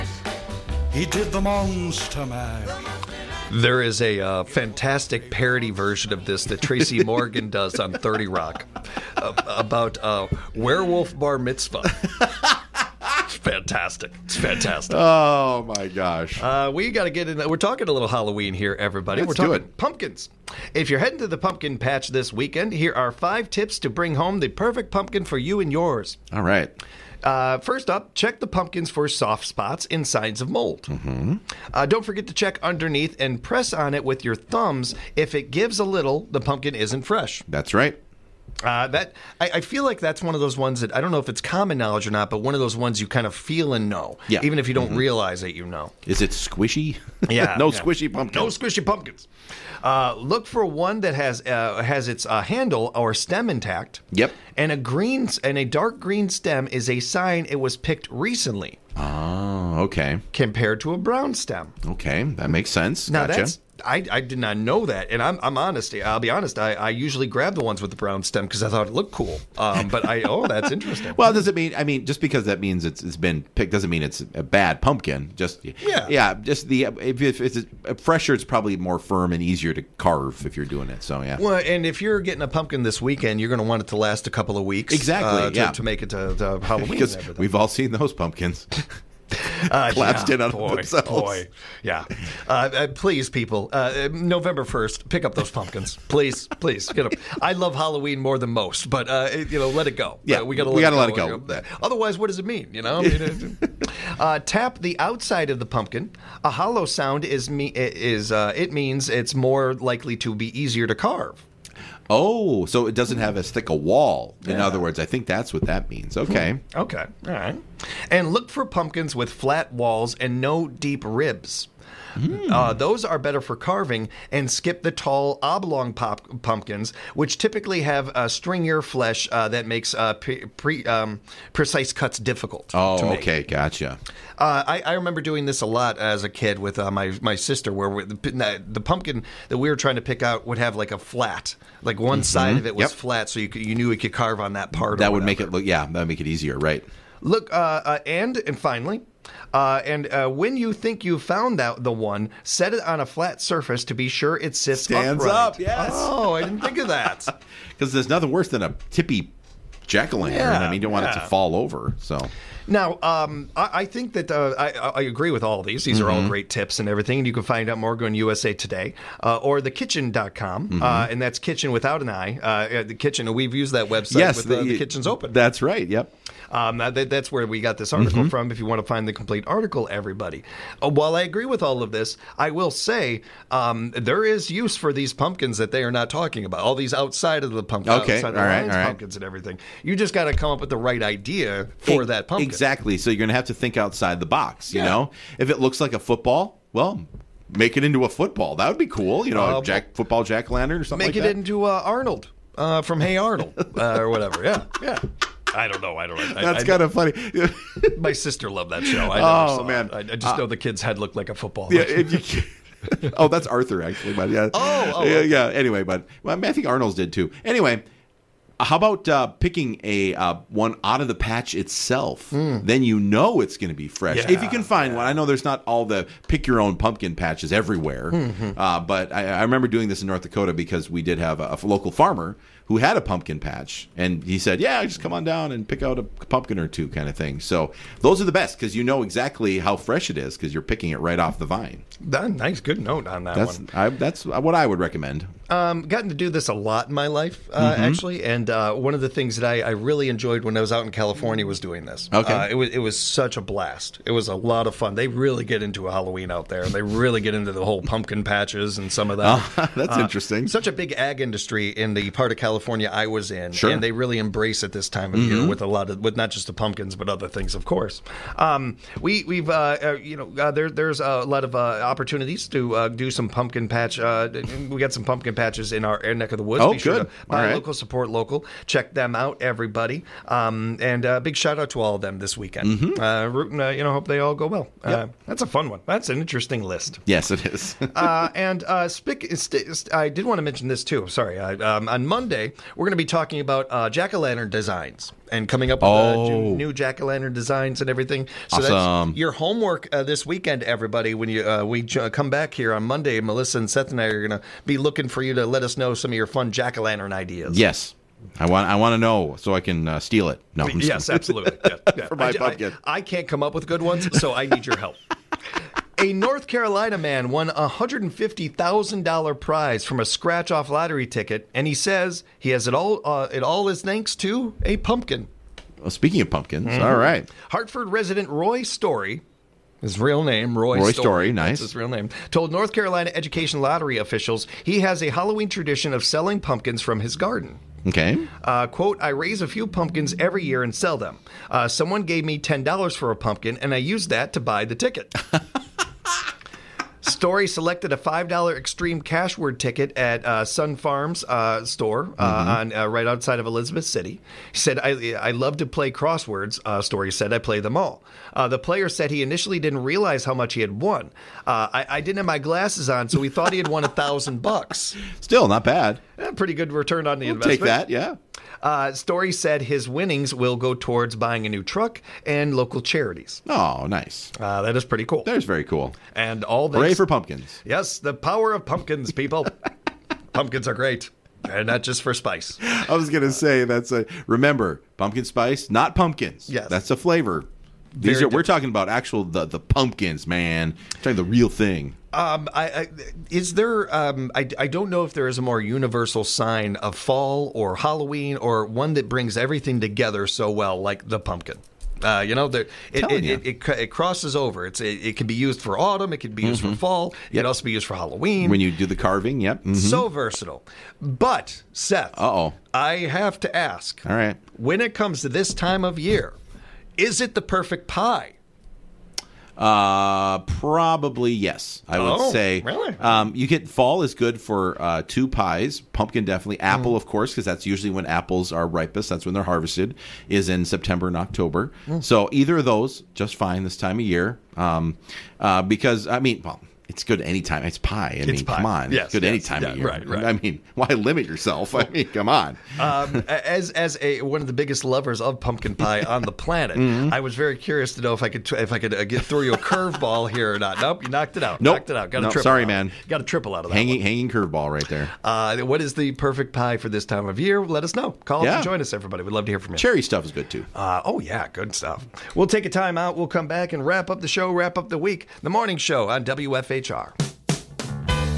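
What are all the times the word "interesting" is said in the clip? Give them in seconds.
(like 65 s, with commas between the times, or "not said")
70 s, 260 s, 286 s.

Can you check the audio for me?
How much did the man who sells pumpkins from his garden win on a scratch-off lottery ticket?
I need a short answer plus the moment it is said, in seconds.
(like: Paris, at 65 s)
$150,000, at 317 s.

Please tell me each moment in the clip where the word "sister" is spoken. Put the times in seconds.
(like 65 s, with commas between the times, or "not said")
137 s, 208 s.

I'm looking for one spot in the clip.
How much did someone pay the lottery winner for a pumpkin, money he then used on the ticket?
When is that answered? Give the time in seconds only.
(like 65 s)
342 s.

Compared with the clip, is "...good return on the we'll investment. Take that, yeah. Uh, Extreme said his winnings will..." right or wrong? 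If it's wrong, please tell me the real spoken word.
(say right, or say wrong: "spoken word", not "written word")
wrong: "Story", not "Extreme".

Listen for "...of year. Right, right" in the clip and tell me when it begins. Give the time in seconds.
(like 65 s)
439 s.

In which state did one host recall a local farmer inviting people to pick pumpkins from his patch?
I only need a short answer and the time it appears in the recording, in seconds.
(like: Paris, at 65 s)
North Dakota, at 230 s.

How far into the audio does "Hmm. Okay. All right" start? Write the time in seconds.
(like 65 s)
116 s.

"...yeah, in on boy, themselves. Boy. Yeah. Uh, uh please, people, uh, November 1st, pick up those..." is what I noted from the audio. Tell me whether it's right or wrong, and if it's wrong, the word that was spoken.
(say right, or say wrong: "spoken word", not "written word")
right.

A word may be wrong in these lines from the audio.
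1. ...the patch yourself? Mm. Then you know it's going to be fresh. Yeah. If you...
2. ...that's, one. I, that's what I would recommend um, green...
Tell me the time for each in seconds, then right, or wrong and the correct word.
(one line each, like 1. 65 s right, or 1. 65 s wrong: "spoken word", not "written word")
1. 221 s wrong: "itself", not "yourself"
2. 243 s wrong: "gotten", not "green".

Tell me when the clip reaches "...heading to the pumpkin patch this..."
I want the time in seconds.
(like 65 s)
20 s.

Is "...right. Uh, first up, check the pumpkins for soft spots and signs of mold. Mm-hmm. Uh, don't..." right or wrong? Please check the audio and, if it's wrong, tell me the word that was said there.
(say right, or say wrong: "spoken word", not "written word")
right.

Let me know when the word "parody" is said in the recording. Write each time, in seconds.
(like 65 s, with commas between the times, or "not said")
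5 s.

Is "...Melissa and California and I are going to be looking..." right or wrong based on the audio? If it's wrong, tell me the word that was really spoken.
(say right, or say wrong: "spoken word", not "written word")
wrong: "Seth", not "California".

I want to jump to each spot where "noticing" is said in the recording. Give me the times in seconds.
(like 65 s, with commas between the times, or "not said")
not said.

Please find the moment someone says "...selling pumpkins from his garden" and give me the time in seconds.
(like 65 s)
336 s.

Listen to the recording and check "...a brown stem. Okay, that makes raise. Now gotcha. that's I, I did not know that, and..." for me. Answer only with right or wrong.
wrong.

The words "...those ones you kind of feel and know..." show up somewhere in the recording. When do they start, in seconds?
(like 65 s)
42 s.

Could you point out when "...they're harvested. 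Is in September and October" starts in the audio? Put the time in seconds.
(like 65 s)
429 s.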